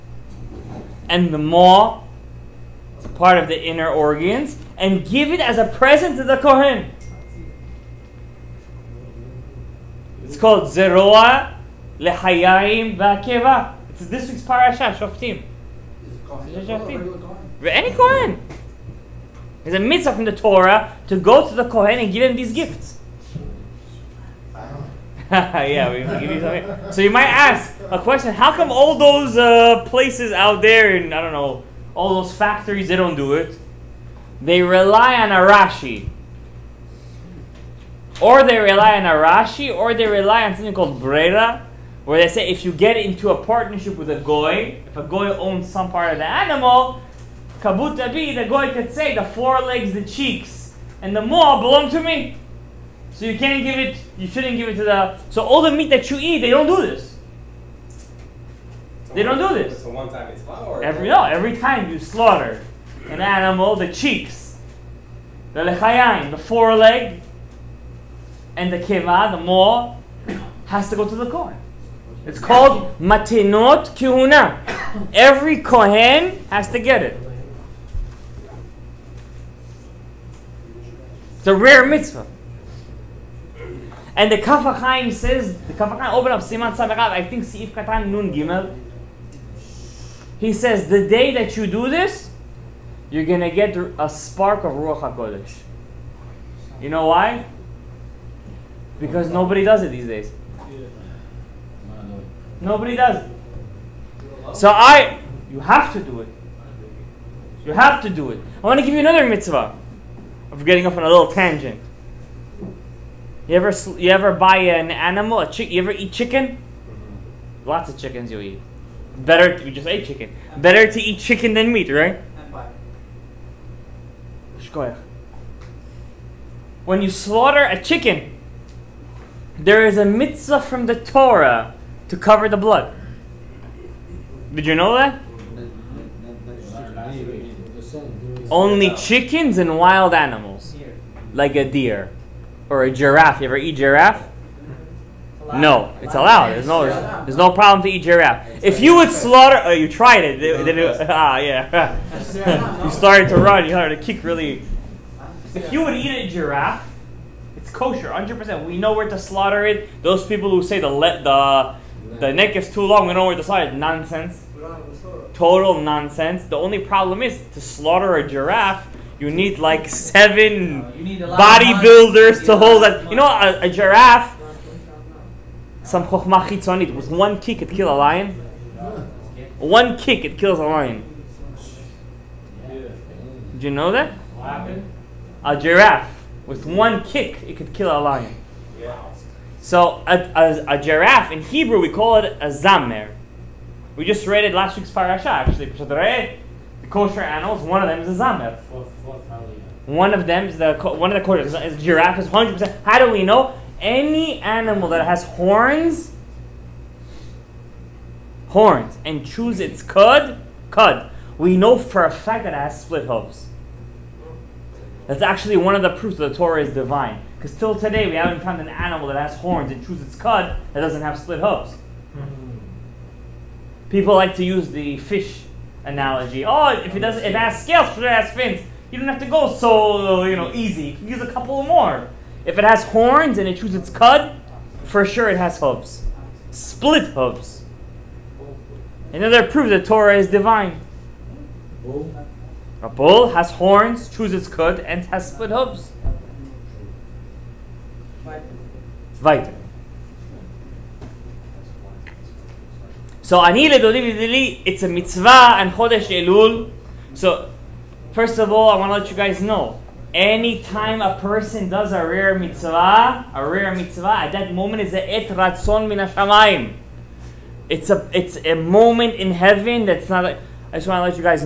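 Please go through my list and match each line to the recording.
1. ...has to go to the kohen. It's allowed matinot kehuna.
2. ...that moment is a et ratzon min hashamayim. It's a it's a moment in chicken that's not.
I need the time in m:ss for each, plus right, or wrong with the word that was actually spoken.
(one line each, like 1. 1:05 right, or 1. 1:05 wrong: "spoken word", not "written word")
1. 1:10 wrong: "called", not "allowed"
2. 4:24 wrong: "heaven", not "chicken".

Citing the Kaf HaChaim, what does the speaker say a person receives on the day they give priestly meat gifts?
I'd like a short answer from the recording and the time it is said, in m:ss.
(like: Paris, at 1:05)
A spark of Ruach HaKodesh, at 1:34.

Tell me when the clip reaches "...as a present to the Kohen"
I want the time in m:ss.
0:05.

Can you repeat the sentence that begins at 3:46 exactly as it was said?
Oh, if it doesn't, if it has scales, If it has fins?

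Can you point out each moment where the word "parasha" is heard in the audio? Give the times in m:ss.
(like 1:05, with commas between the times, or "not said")
0:14, 3:14.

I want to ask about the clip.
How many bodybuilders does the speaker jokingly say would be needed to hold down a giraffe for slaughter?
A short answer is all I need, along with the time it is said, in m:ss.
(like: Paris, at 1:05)
7, at 2:49.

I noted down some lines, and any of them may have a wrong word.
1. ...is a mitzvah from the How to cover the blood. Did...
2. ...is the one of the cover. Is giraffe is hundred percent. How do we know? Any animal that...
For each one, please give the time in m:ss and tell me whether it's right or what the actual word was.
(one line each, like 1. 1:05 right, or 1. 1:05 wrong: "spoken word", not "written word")
1. 2:09 wrong: "Torah", not "How"
2. 3:20 wrong: "kosher", not "cover".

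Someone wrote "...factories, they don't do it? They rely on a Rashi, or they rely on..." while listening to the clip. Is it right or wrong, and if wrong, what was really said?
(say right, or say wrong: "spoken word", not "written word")
right.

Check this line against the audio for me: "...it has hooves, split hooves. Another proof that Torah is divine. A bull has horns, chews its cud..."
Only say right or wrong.
right.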